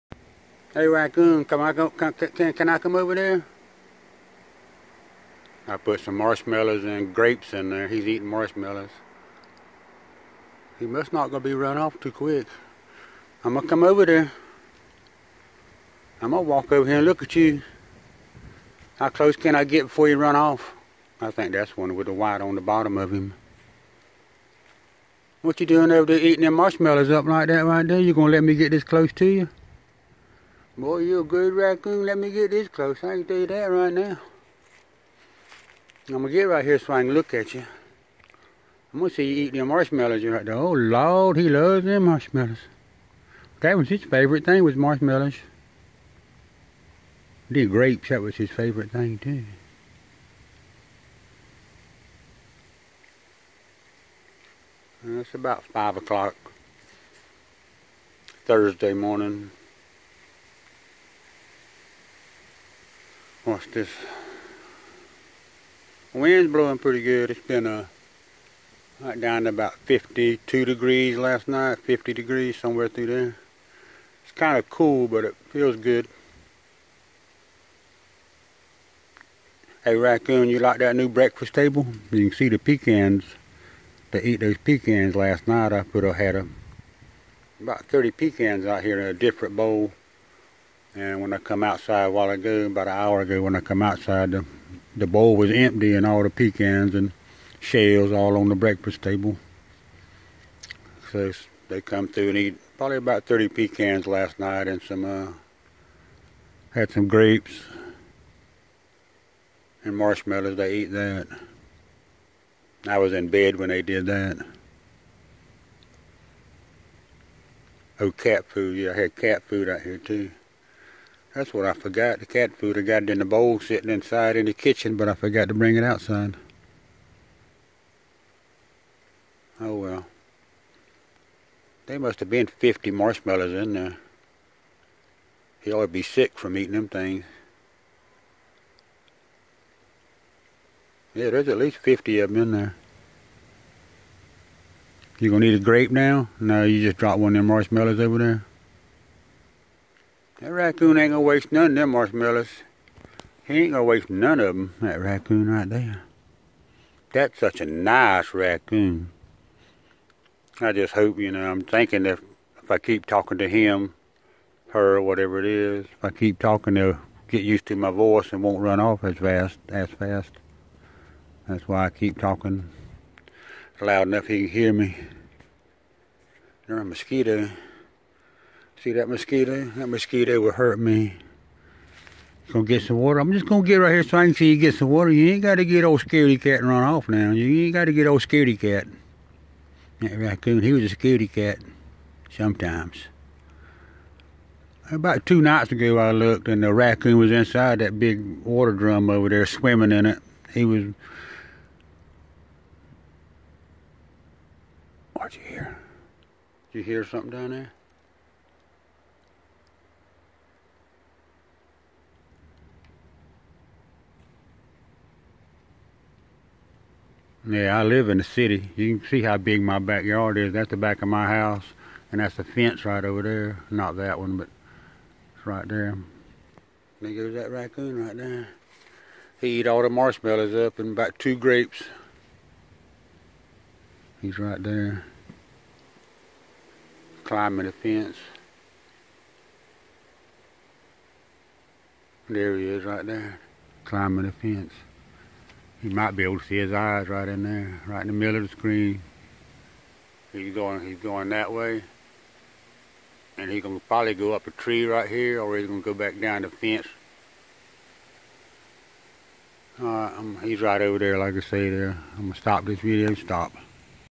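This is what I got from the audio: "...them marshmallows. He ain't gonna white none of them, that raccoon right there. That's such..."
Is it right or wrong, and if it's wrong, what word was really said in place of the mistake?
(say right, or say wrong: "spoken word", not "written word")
wrong: "waste", not "white".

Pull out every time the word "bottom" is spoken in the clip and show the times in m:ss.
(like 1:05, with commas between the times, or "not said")
0:22.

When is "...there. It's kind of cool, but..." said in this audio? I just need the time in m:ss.
1:13.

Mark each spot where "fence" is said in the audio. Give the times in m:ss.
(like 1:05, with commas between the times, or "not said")
3:42, 3:57, 4:04, 4:16.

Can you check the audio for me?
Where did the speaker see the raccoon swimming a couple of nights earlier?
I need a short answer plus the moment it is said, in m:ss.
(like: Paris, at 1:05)
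Big water drum, at 3:17.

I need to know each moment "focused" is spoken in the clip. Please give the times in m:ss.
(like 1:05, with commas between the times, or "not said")
not said.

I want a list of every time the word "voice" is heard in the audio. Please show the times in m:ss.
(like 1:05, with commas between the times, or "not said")
2:47.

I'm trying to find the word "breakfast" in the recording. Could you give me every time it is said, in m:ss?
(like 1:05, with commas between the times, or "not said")
1:21, 1:38.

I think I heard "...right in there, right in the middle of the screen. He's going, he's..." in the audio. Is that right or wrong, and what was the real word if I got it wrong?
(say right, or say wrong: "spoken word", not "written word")
right.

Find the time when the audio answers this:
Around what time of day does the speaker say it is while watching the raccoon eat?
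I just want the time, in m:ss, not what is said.
0:55.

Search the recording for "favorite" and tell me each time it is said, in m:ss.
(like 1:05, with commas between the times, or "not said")
0:44, 0:48.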